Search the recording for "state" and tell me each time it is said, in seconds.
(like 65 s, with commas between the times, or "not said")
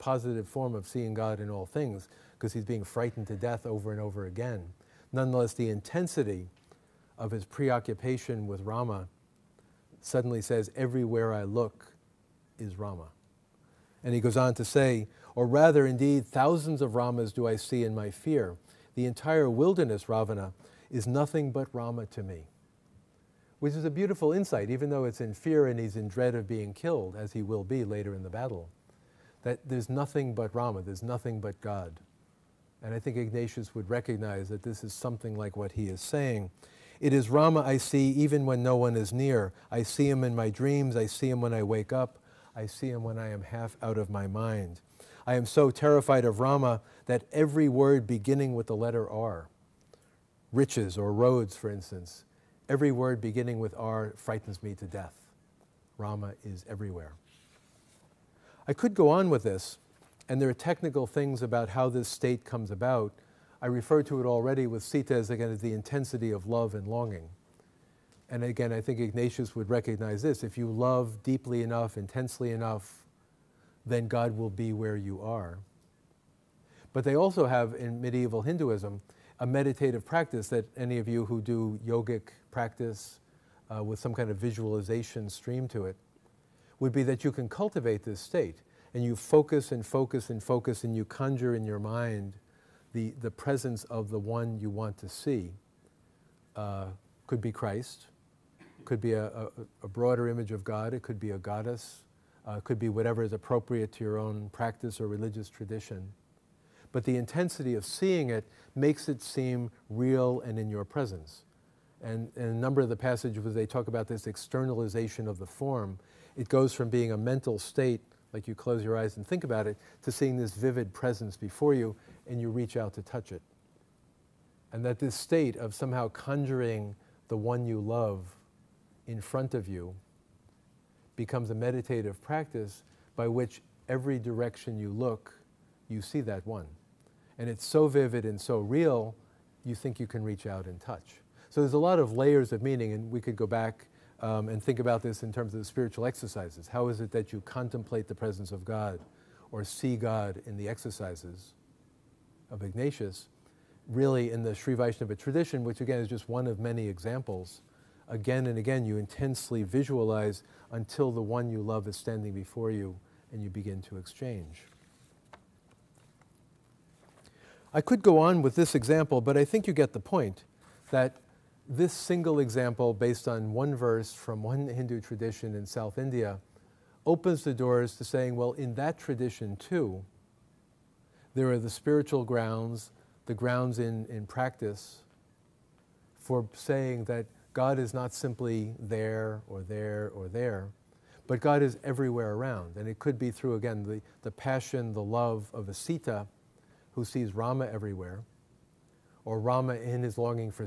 62 s, 88 s, 117 s, 125 s.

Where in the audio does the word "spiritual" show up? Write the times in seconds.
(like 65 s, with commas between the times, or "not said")
145 s, 181 s.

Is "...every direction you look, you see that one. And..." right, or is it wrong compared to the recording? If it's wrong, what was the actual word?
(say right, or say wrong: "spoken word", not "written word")
right.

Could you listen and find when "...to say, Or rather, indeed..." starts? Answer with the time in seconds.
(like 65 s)
14 s.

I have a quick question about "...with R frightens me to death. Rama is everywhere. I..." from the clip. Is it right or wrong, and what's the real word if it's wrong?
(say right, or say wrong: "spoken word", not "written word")
right.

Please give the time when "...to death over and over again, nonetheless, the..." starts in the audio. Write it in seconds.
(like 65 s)
3 s.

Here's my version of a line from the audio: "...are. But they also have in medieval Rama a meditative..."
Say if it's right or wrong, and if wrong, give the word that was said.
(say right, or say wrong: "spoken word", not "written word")
wrong: "Hinduism", not "Rama".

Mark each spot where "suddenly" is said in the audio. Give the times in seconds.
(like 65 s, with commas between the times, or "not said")
10 s.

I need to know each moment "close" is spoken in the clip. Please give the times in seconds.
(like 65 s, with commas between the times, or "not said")
118 s.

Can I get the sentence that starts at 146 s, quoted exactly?
How is it that you contemplate the presence of God or see God in the exercises of Ignatius?